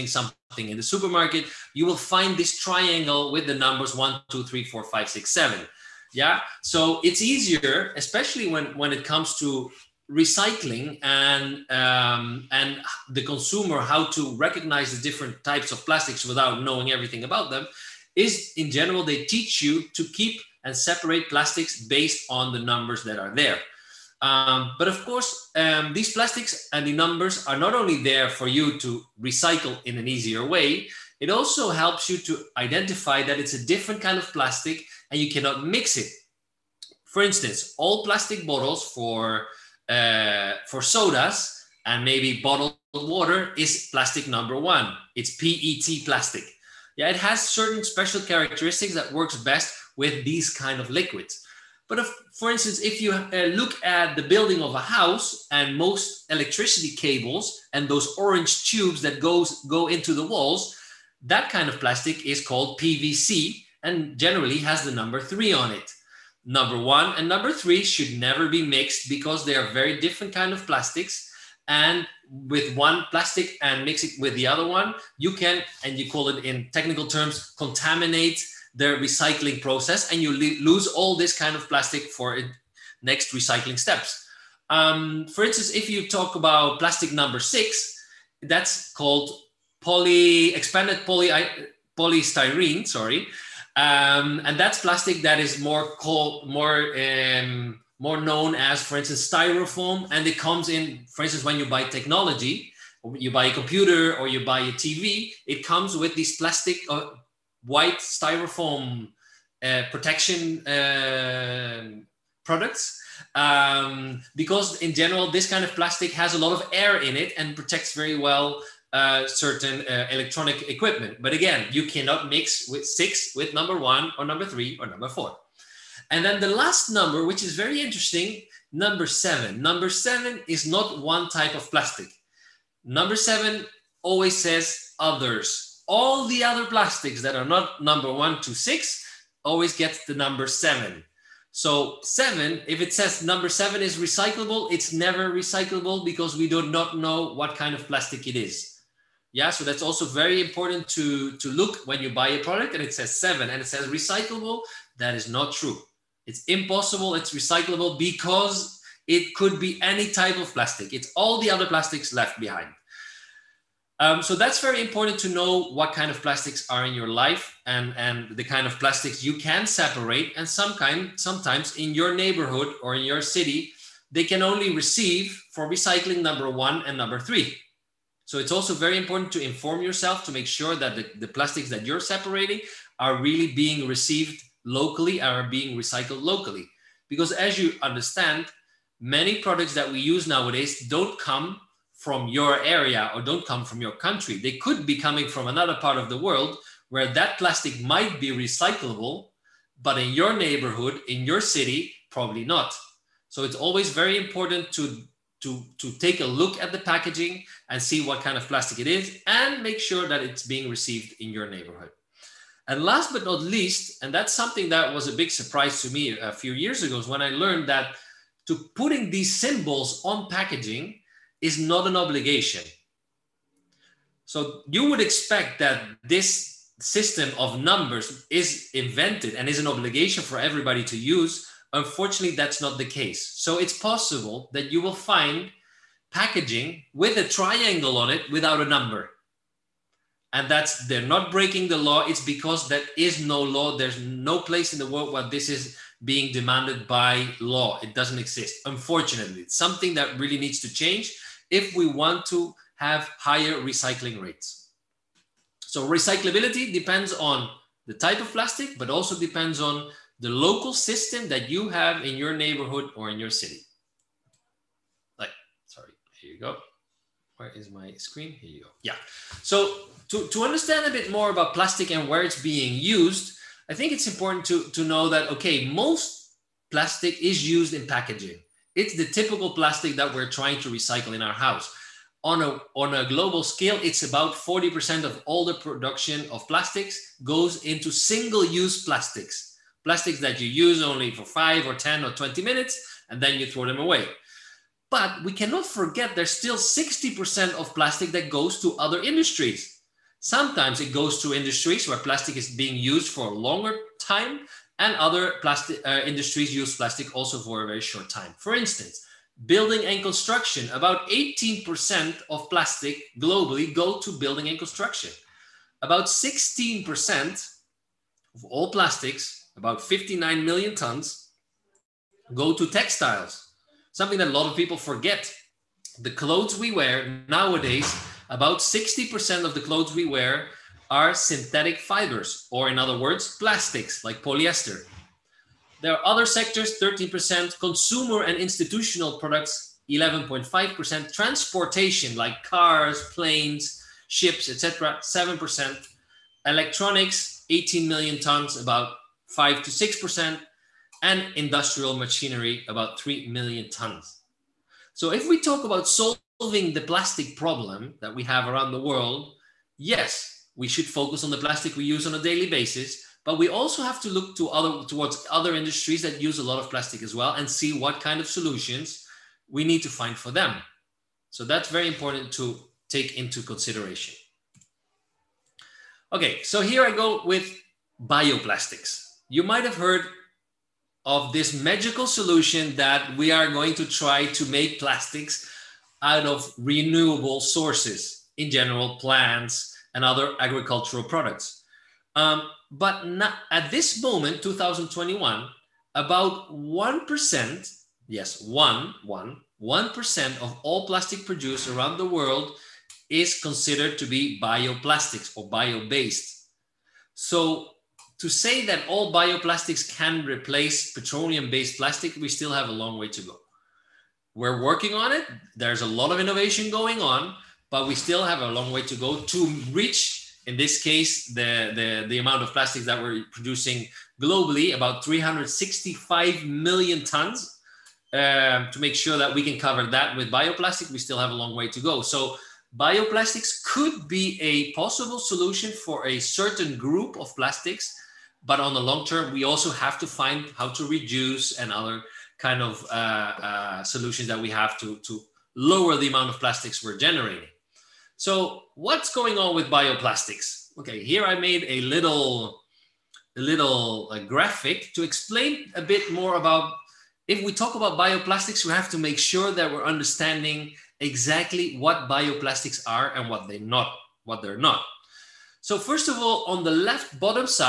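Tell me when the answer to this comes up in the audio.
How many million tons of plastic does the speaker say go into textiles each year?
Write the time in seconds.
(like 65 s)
319 s.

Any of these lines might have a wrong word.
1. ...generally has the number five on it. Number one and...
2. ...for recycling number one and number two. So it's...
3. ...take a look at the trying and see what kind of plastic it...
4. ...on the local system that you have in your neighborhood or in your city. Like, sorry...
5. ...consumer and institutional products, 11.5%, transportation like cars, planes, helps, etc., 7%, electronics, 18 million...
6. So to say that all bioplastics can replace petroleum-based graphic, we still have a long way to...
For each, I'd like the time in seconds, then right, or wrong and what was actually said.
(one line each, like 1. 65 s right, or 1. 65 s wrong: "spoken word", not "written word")
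1. 64 s wrong: "three", not "five"
2. 175 s wrong: "three", not "two"
3. 205 s wrong: "packaging", not "trying"
4. 259 s right
5. 337 s wrong: "ships", not "helps"
6. 407 s wrong: "plastic", not "graphic".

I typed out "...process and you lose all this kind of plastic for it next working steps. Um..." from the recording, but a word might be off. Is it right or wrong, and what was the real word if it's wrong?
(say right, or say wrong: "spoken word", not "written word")
wrong: "recycling", not "working".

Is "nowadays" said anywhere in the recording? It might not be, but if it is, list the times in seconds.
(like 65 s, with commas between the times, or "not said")
190 s, 327 s.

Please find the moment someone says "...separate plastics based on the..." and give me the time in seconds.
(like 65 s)
20 s.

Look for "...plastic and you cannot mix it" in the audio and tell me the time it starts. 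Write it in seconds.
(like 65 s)
34 s.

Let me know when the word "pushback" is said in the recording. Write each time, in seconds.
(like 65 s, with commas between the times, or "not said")
not said.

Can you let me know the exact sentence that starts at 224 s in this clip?
So you would expect that this system of numbers is invented and is an obligation for everybody to use.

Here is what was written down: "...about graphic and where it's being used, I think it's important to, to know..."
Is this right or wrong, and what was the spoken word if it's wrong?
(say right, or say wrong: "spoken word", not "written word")
wrong: "plastic", not "graphic".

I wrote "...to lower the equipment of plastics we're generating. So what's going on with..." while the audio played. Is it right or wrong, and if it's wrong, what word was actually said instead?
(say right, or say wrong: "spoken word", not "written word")
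wrong: "amount", not "equipment".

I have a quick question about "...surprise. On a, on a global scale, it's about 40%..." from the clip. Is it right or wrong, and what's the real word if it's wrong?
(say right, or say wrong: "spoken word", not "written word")
wrong: "house", not "surprise".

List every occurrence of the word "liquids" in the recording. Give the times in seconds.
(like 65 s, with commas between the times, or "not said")
50 s.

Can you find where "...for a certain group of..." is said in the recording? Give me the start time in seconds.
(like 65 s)
435 s.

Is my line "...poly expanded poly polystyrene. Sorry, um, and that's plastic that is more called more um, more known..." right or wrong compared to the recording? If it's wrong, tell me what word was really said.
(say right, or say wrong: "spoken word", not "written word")
right.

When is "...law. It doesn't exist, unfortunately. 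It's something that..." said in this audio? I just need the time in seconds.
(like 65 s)
247 s.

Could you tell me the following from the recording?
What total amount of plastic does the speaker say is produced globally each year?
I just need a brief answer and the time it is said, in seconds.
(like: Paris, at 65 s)
365 million tons, at 425 s.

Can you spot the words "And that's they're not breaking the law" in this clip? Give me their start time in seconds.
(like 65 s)
240 s.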